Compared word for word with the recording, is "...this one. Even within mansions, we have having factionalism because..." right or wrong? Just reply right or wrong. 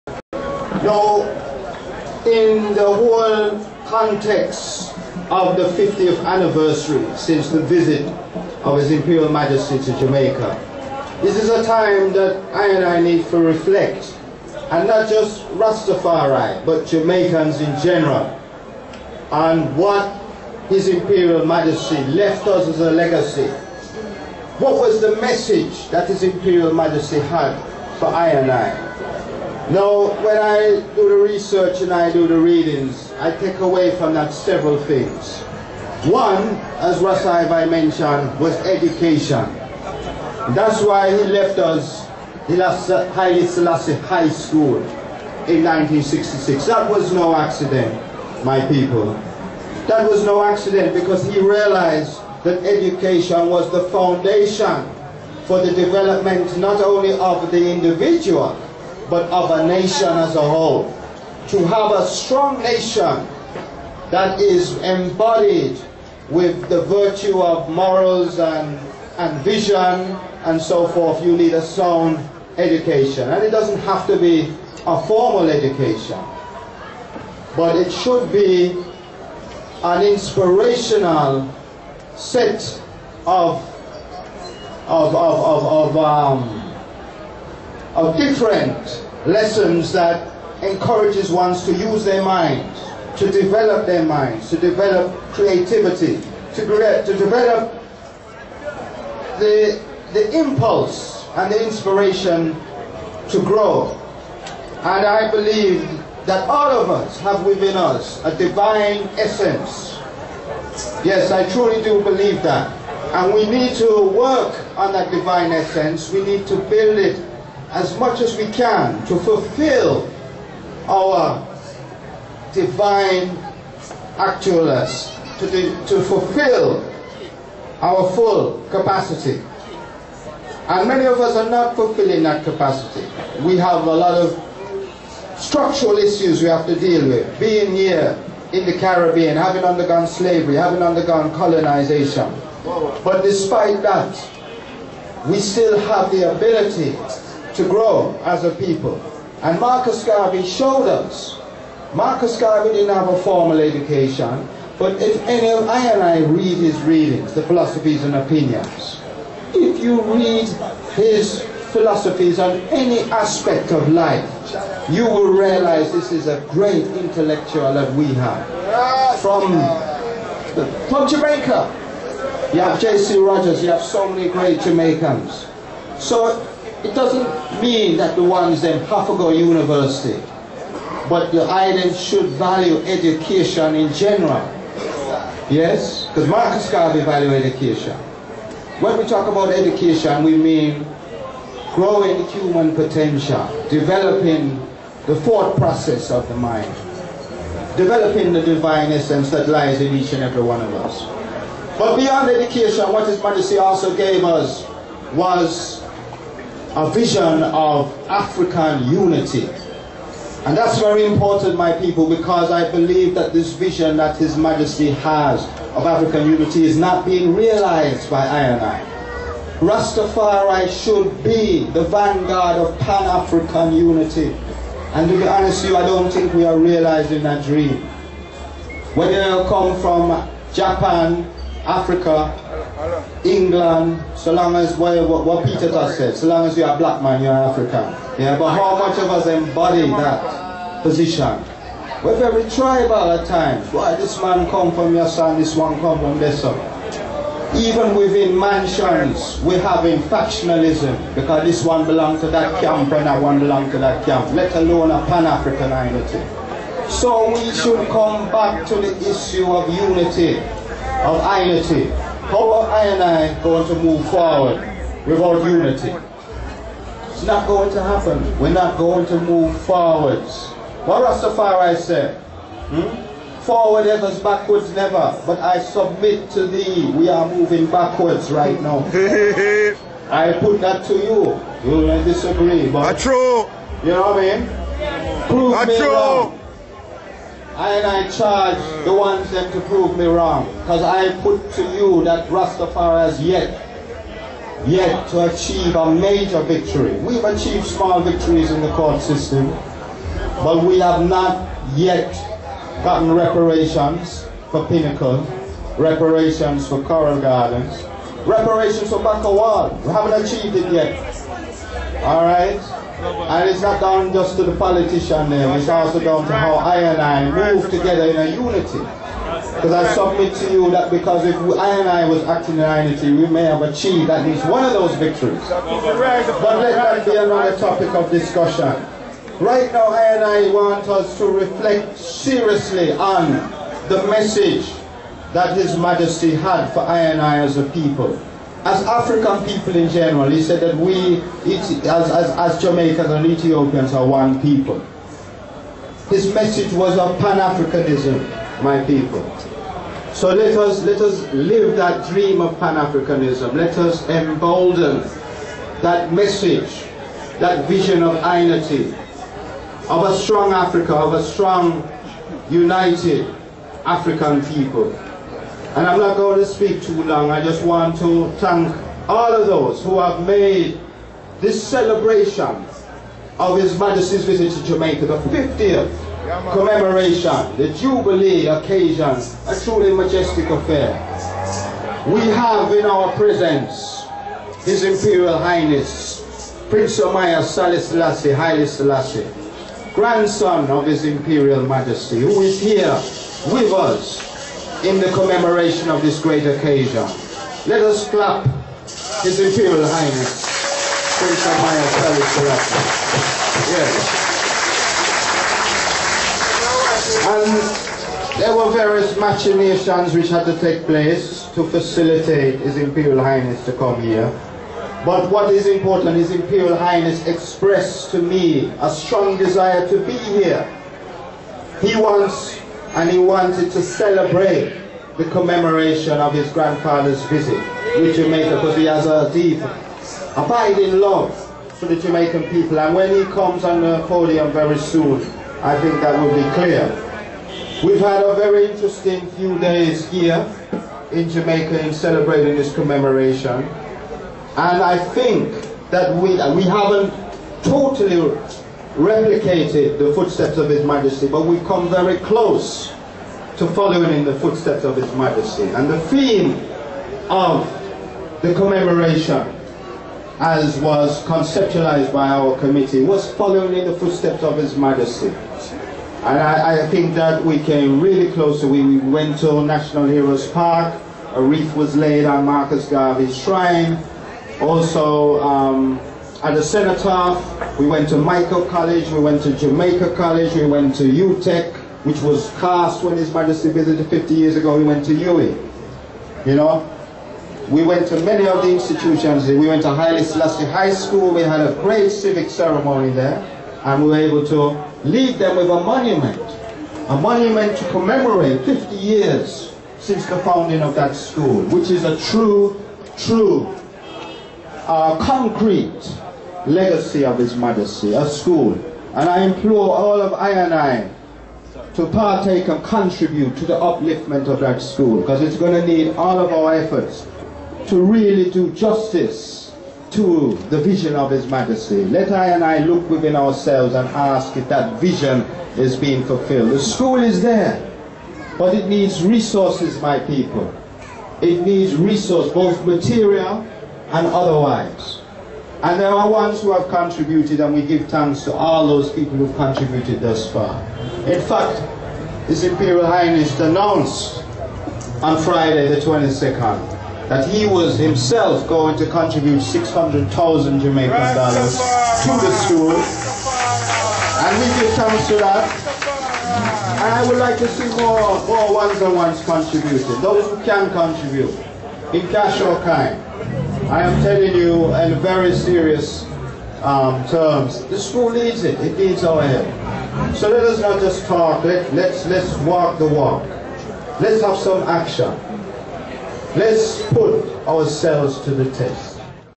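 right.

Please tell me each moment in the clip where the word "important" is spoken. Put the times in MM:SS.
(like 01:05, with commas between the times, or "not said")
03:31, 06:55.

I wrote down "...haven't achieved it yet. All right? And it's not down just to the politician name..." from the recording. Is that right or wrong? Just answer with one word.
right.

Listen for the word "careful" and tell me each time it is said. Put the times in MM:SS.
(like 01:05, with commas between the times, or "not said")
not said.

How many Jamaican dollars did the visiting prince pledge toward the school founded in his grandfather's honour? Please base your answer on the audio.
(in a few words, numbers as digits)
600,000.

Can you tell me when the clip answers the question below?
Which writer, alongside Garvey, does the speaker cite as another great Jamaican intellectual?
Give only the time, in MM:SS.
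02:52.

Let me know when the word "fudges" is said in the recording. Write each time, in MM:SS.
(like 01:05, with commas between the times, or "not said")
not said.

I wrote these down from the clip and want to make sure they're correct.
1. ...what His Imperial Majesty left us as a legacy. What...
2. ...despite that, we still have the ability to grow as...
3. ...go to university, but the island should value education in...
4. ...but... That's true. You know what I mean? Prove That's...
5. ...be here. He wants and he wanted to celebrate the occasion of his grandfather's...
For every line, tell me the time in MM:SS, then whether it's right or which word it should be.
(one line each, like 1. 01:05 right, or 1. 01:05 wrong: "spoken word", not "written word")
1. 00:19 right
2. 02:23 right
3. 02:59 right
4. 04:42 right
5. 07:00 wrong: "commemoration", not "occasion".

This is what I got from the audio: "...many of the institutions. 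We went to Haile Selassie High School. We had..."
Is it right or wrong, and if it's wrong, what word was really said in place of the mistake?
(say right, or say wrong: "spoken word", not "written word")
right.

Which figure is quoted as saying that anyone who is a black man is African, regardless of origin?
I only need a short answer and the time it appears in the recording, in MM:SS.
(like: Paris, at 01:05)
Peter Tosh, at 03:55.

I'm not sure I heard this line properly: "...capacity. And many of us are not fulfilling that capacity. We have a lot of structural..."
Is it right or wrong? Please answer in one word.
right.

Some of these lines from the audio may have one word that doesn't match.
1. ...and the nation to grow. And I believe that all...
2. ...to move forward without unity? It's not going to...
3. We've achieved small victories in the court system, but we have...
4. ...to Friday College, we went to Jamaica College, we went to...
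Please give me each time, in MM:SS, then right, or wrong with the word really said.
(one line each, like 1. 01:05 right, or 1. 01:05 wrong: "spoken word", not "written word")
1. 01:41 wrong: "inspiration", not "nation"
2. 04:23 right
3. 04:56 right
4. 07:58 wrong: "Mico", not "Friday".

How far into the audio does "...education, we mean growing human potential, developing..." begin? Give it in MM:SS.
03:09.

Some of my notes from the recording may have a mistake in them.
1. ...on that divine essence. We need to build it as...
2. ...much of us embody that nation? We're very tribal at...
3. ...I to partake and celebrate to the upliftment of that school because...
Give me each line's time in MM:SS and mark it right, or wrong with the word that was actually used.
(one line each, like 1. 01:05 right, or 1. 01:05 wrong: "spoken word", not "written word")
1. 01:54 right
2. 03:58 wrong: "position", not "nation"
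3. 08:30 wrong: "contribute", not "celebrate".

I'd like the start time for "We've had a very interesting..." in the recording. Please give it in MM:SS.
07:17.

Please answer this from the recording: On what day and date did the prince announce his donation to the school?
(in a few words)
Friday the 22nd.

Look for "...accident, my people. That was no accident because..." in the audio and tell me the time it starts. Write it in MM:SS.
00:47.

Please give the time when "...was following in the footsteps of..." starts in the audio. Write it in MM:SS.
07:43.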